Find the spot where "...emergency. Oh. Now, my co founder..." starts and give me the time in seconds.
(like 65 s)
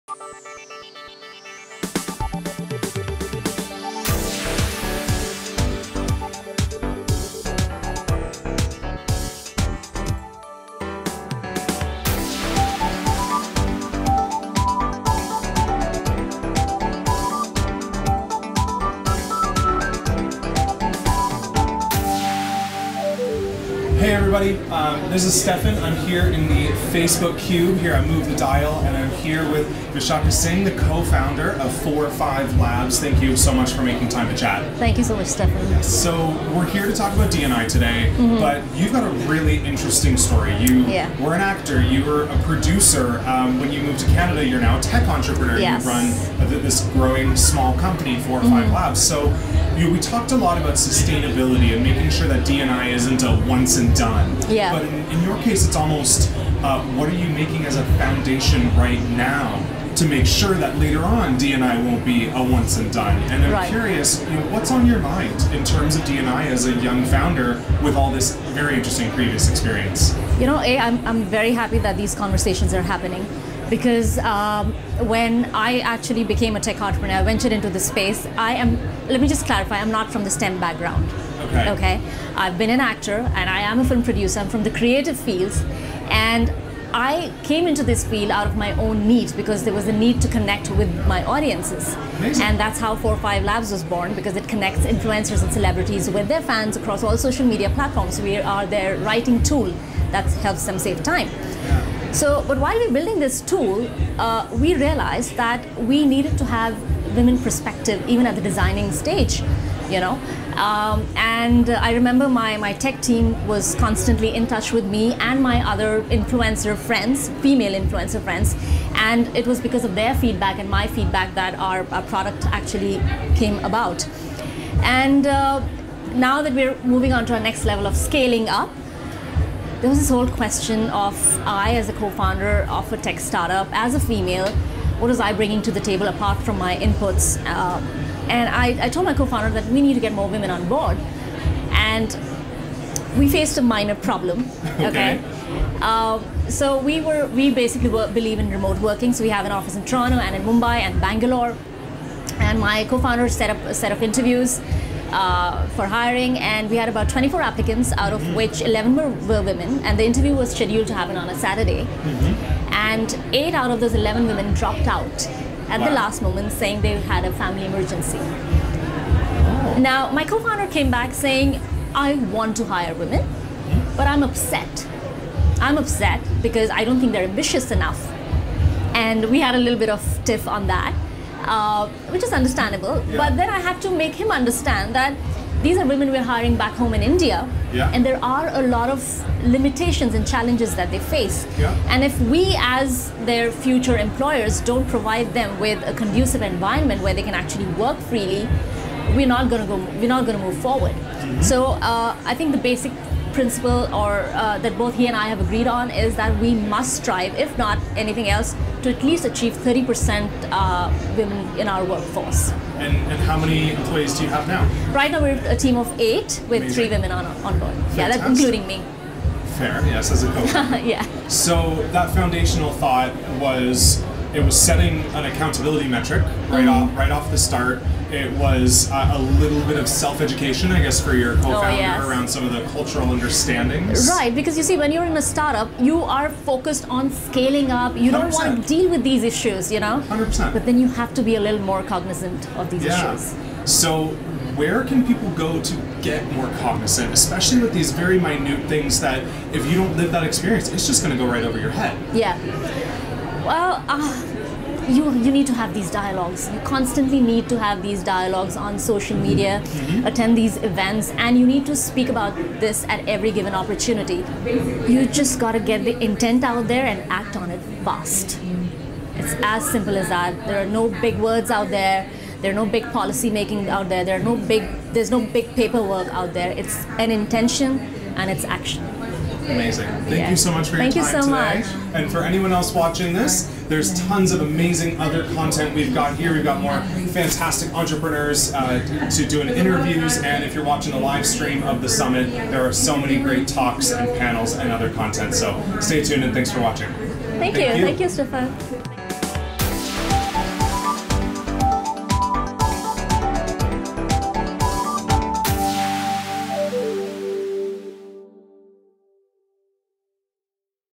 167 s.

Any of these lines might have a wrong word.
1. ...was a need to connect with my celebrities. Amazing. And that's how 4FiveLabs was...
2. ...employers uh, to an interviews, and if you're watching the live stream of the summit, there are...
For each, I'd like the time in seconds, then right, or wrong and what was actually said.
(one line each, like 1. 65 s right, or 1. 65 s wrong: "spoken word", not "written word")
1. 89 s wrong: "audiences", not "celebrities"
2. 287 s wrong: "entrepreneurs", not "employers".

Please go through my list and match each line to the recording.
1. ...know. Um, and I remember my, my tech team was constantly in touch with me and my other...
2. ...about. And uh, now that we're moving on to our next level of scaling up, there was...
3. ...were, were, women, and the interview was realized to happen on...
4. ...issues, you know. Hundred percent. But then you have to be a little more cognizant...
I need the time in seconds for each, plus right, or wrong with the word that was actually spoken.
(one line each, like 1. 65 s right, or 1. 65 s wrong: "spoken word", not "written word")
1. 109 s right
2. 123 s right
3. 158 s wrong: "scheduled", not "realized"
4. 239 s right.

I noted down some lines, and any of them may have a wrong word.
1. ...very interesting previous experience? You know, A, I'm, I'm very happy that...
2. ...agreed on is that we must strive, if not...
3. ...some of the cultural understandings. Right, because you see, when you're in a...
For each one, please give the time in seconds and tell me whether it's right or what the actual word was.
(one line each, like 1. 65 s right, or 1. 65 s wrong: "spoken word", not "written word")
1. 68 s right
2. 205 s right
3. 232 s right.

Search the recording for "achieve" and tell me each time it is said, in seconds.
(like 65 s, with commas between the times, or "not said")
209 s.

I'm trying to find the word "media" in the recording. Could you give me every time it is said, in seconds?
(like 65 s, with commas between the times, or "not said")
97 s, 259 s.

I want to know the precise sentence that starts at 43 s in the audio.
Um, when you moved to Canada, you're now a tech entrepreneur.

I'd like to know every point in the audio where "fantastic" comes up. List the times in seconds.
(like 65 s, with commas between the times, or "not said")
217 s, 287 s.